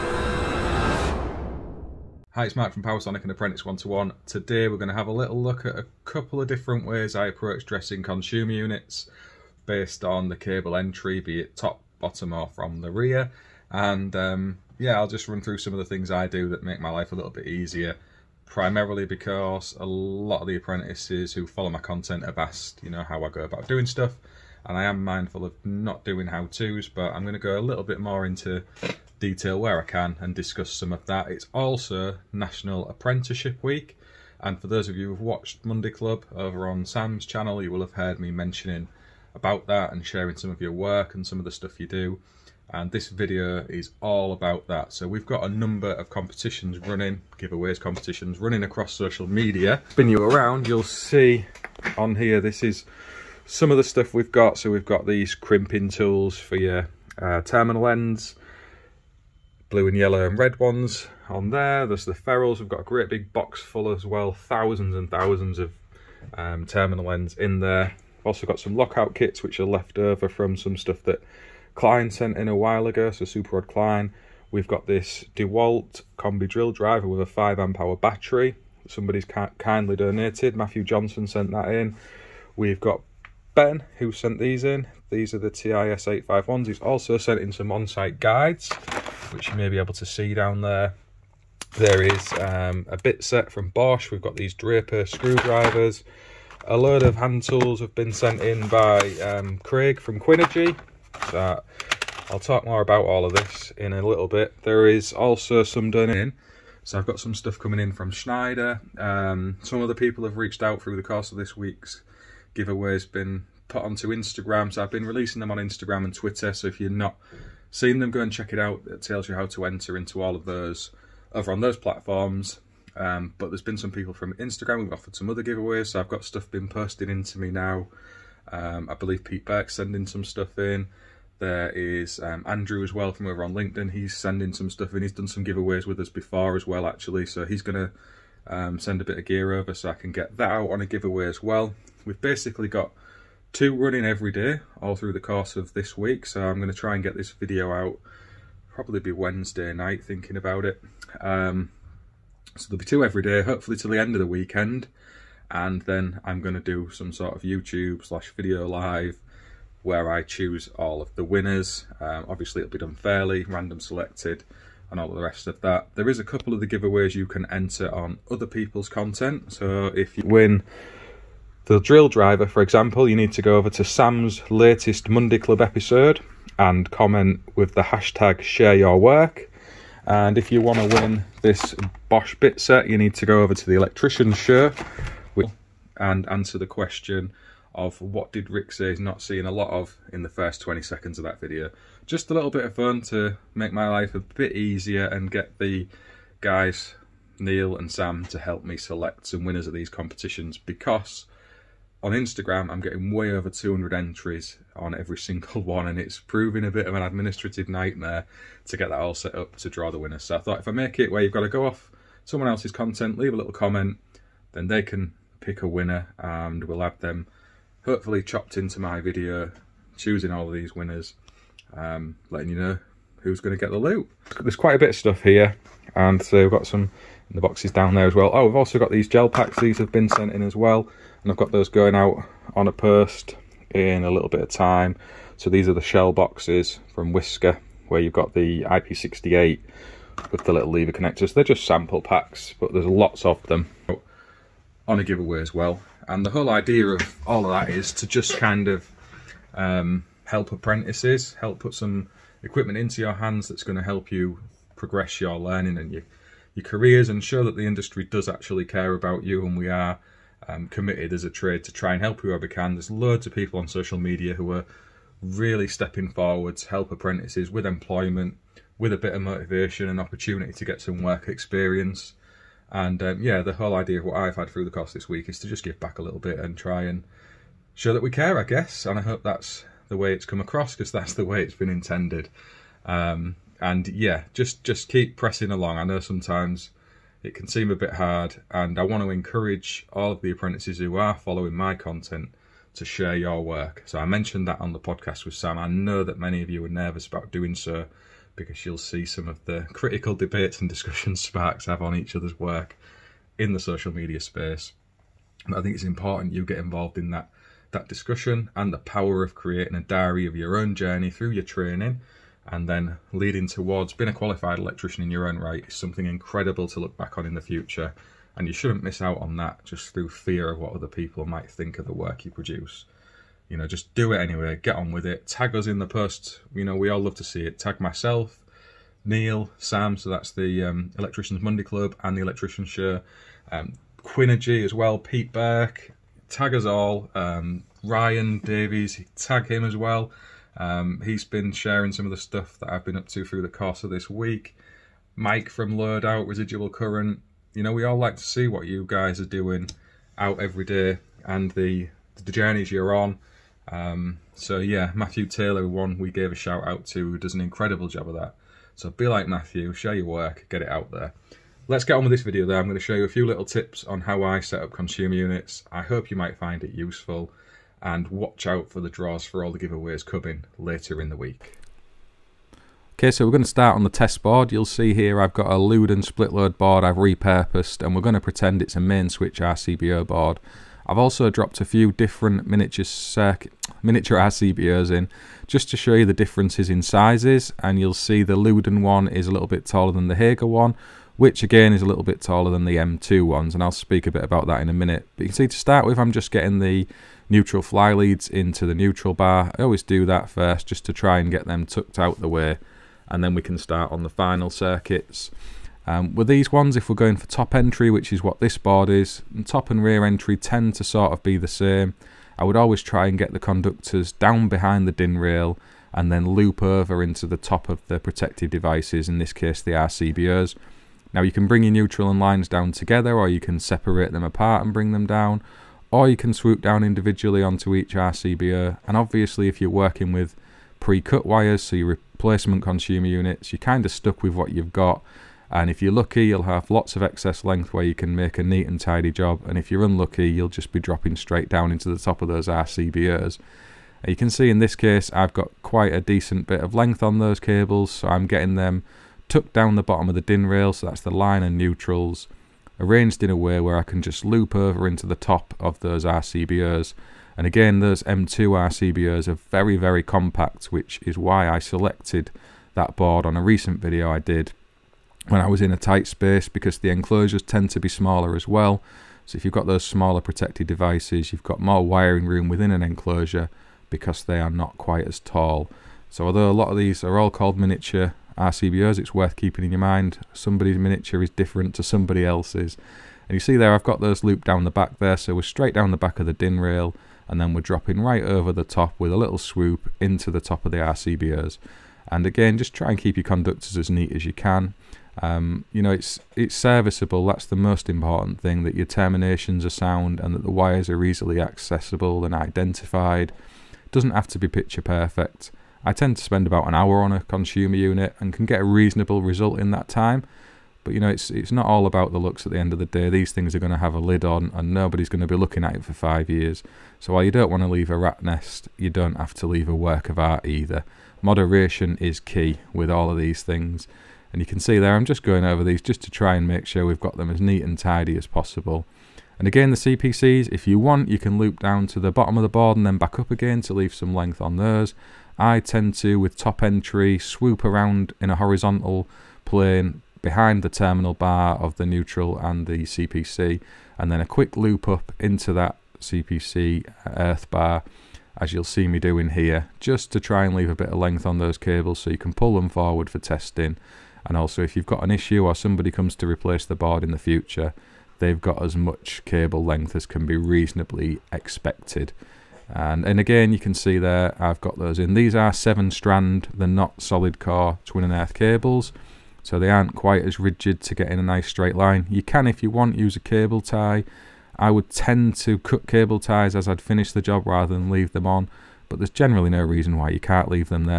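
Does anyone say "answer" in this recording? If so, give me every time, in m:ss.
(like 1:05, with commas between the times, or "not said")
3:06.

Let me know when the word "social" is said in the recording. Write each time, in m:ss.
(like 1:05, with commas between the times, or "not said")
0:48, 4:23, 5:03.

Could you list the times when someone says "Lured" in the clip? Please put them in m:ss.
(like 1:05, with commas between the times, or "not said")
5:45.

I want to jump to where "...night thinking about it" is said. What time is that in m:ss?
2:29.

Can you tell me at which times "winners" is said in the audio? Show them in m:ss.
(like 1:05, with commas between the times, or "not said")
2:41, 3:19, 3:29, 3:35, 3:40.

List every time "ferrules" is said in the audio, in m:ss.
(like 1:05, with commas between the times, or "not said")
1:02.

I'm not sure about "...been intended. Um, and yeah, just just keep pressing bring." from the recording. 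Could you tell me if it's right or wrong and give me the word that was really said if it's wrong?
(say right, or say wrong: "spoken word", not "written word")
wrong: "along", not "bring".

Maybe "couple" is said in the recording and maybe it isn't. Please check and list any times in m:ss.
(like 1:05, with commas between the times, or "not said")
0:06, 2:46.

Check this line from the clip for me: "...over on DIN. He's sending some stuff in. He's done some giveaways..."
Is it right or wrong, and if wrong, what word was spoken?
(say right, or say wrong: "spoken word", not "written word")
wrong: "LinkedIn", not "DIN".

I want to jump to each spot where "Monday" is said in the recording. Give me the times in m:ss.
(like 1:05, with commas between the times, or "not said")
0:35, 2:55, 5:31.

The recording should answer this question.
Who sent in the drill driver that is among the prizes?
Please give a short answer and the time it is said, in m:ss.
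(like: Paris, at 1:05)
Matthew Johnson, at 1:20.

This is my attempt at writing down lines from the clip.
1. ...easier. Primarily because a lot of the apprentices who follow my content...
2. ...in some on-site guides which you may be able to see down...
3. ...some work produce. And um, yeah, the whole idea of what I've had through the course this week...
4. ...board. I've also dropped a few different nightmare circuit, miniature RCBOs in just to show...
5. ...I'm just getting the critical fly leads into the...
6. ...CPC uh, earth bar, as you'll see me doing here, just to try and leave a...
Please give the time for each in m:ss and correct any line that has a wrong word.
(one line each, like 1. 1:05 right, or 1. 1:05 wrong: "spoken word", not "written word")
1. 0:17 right
2. 1:27 right
3. 4:30 wrong: "experience", not "produce"
4. 6:20 wrong: "miniature", not "nightmare"
5. 6:35 wrong: "neutral", not "critical"
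6. 9:05 right.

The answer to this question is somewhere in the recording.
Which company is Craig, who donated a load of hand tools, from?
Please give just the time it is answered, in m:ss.
1:40.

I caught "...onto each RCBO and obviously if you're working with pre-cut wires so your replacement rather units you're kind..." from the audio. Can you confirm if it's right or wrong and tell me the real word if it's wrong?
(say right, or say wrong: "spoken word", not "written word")
wrong: "consumer", not "rather".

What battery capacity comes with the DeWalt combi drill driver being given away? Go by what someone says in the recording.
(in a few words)
5 amp hour.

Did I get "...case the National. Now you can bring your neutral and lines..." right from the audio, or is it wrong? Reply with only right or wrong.
wrong.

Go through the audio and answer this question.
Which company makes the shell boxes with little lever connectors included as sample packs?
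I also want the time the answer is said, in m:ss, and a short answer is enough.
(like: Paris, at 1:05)
Wiska, at 3:57.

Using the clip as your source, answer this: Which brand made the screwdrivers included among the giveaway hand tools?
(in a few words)
Draper.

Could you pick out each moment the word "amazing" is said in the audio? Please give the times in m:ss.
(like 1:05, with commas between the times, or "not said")
not said.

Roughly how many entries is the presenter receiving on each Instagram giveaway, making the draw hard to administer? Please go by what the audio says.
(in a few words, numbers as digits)
over 200.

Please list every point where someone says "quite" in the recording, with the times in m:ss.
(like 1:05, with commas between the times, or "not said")
3:44, 7:25, 7:54, 9:29.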